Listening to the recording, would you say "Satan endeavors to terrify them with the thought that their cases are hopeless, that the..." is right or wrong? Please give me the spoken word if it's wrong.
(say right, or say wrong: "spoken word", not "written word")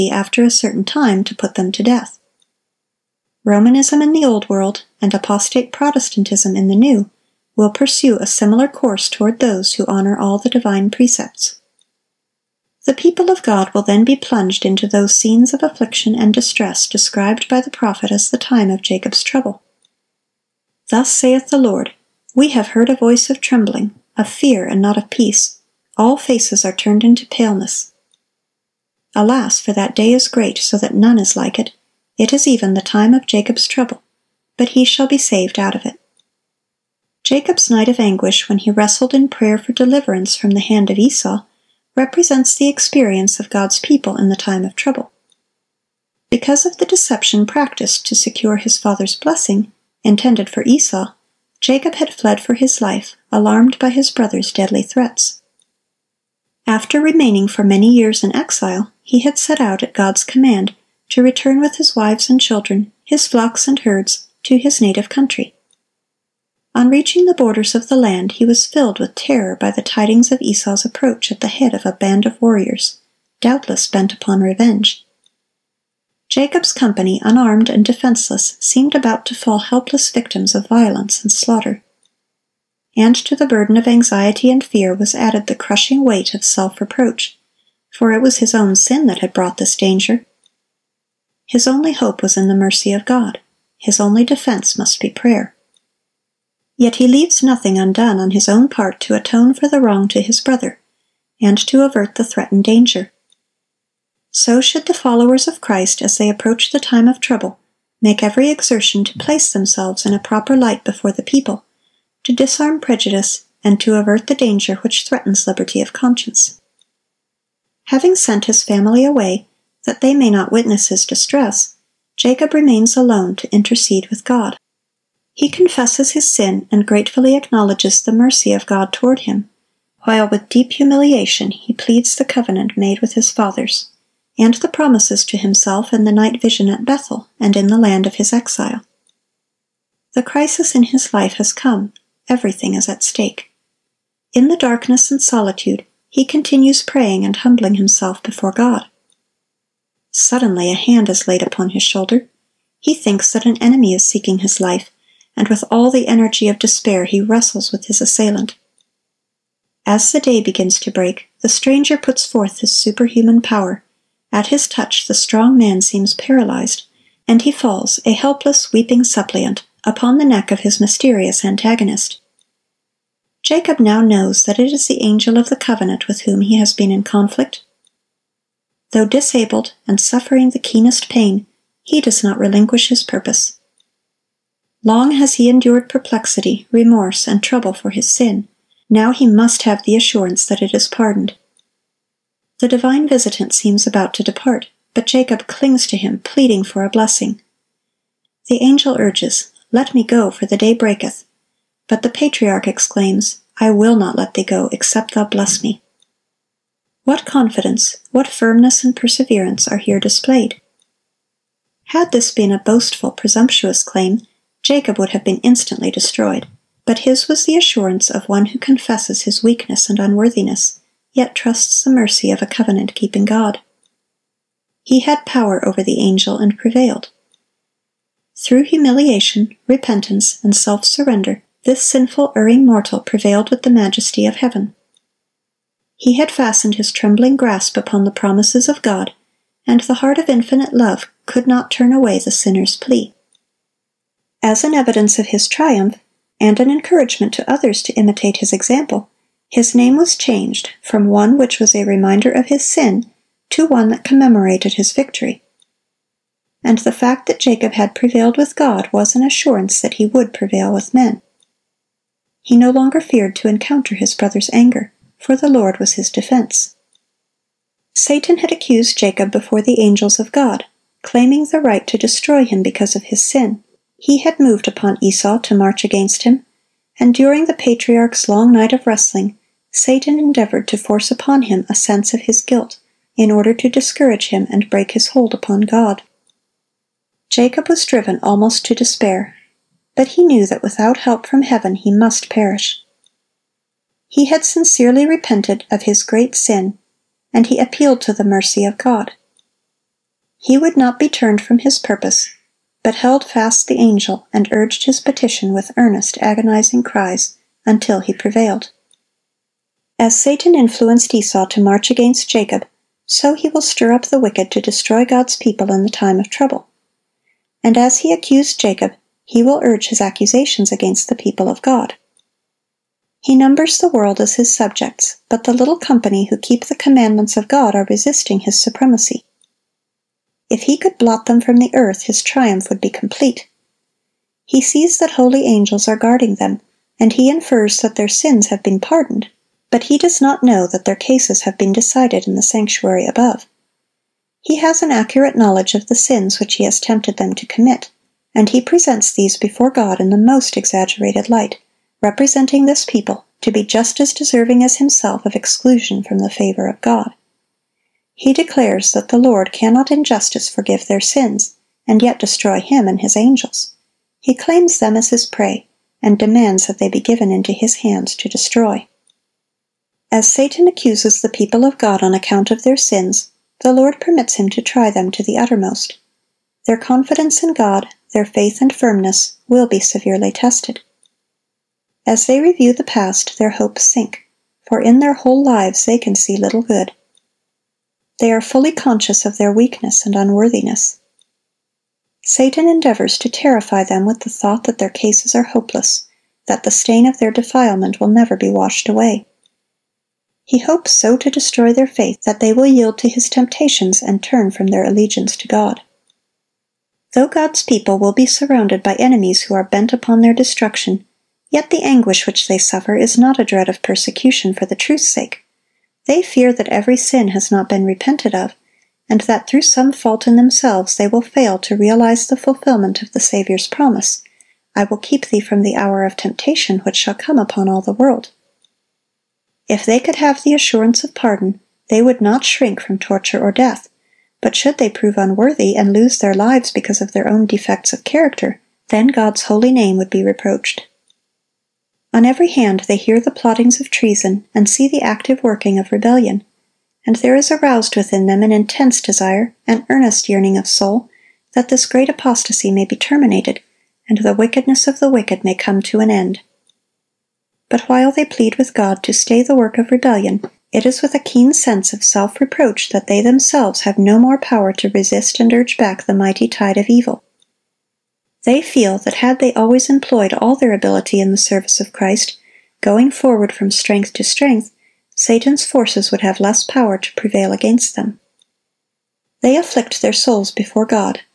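right.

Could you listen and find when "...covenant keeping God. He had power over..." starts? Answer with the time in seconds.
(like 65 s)
222 s.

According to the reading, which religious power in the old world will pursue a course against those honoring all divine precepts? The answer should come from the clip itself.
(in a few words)
Romanism.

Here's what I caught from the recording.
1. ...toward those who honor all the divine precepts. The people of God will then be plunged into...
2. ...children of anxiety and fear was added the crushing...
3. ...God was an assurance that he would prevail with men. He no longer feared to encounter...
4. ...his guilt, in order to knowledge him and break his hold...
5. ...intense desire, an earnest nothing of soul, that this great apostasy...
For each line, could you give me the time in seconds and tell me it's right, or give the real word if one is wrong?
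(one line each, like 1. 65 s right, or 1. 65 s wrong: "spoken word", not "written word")
1. 9 s right
2. 83 s wrong: "burden", not "children"
3. 258 s right
4. 282 s wrong: "discourage", not "knowledge"
5. 448 s wrong: "yearning", not "nothing".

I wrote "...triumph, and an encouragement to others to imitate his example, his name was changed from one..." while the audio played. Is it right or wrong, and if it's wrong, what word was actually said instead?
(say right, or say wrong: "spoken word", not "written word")
right.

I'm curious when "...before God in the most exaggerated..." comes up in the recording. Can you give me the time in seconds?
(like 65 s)
349 s.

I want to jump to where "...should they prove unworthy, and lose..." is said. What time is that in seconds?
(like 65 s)
434 s.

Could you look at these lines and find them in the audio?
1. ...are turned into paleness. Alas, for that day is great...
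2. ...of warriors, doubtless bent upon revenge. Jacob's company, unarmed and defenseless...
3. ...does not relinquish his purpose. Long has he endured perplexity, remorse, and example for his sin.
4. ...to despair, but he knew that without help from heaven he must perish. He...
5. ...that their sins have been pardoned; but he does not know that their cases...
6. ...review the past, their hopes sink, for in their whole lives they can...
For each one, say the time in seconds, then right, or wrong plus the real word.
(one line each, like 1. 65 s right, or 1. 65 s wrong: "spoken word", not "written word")
1. 26 s right
2. 72 s right
3. 182 s wrong: "trouble", not "example"
4. 288 s right
5. 337 s right
6. 382 s right.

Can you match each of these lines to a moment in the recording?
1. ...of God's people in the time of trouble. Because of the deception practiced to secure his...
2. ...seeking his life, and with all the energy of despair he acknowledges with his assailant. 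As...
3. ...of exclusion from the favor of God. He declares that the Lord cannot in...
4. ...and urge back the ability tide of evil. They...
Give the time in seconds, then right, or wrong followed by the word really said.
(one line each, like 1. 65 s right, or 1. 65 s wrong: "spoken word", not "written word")
1. 43 s right
2. 154 s wrong: "wrestles", not "acknowledges"
3. 355 s right
4. 465 s wrong: "mighty", not "ability".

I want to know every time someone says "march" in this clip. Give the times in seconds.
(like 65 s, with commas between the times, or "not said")
275 s, 311 s.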